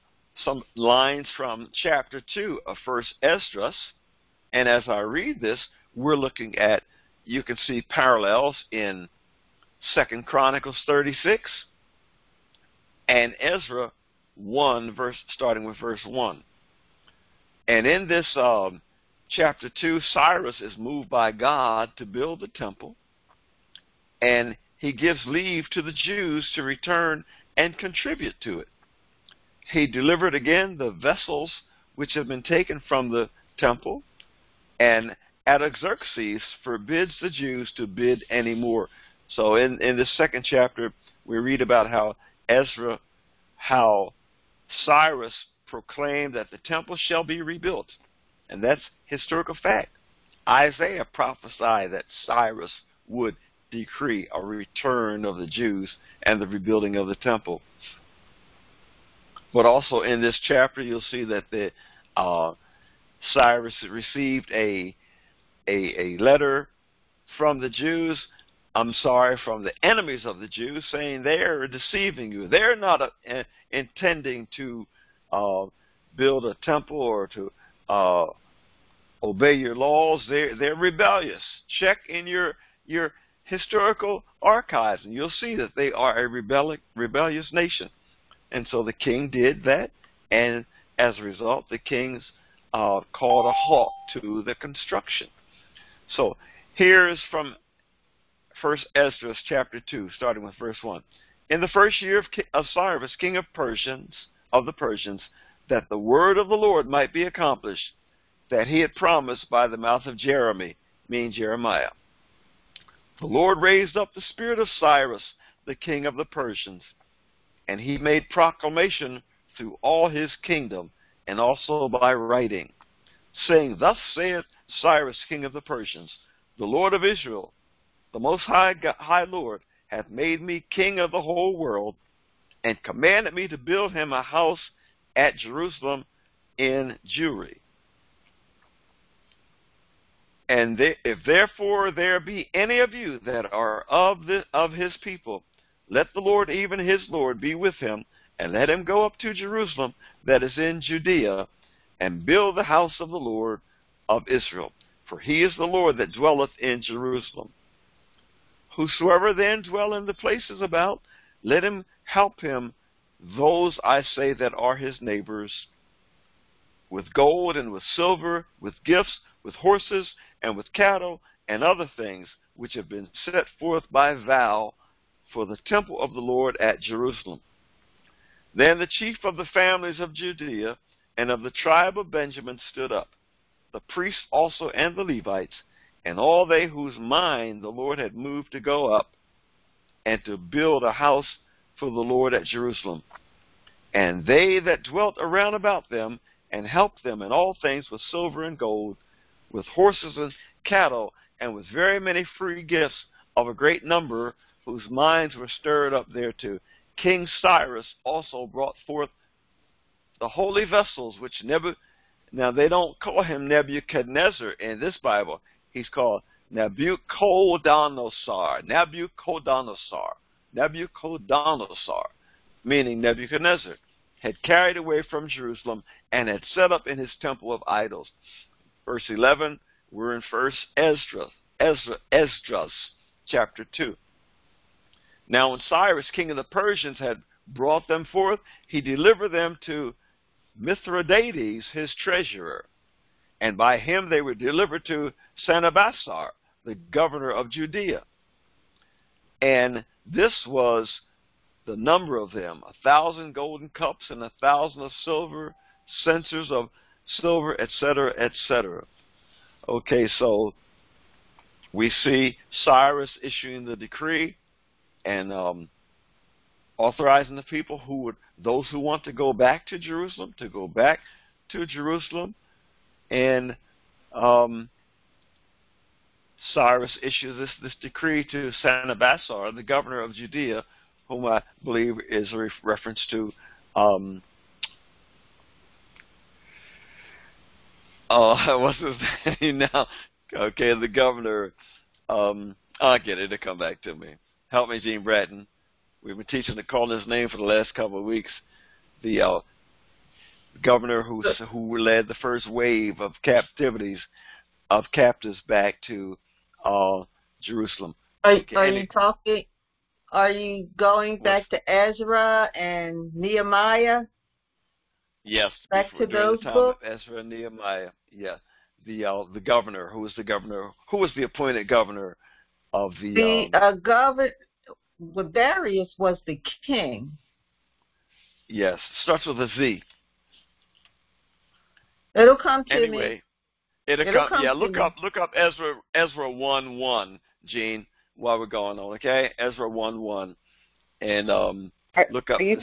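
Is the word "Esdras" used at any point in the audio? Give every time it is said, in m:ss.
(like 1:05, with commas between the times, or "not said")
0:03, 1:38, 3:52.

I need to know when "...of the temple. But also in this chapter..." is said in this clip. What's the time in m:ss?
0:56.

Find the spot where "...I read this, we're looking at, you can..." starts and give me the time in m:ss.
0:04.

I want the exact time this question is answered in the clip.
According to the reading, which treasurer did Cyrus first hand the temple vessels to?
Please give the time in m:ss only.
4:00.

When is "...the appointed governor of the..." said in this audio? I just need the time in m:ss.
5:21.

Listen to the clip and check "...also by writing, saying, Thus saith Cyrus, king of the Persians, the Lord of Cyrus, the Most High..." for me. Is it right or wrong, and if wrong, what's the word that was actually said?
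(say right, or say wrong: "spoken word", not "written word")
wrong: "Israel", not "Cyrus".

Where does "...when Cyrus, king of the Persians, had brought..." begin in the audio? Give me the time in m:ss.
3:55.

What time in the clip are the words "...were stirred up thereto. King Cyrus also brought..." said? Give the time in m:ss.
3:25.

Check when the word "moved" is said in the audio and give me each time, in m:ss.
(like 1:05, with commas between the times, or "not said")
0:20, 3:08.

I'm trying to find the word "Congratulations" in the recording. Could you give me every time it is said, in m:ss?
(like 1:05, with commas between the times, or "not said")
not said.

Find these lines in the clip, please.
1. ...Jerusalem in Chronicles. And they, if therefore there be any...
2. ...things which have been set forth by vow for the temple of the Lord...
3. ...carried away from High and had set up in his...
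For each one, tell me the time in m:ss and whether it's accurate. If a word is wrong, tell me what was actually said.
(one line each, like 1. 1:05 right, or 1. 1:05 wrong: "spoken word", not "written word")
1. 2:15 wrong: "Jewry", not "Chronicles"
2. 2:51 right
3. 3:44 wrong: "Jerusalem", not "High".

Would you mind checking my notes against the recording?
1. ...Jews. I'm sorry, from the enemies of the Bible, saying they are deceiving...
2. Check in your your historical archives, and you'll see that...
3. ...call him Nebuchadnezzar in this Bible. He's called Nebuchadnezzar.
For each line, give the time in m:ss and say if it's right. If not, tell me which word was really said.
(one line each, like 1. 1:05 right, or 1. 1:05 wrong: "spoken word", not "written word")
1. 1:07 wrong: "Jews", not "Bible"
2. 1:21 right
3. 3:32 wrong: "Nabuchodonosor", not "Nebuchadnezzar".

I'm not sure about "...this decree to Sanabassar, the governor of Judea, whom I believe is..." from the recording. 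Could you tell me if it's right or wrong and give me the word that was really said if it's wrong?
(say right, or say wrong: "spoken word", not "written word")
right.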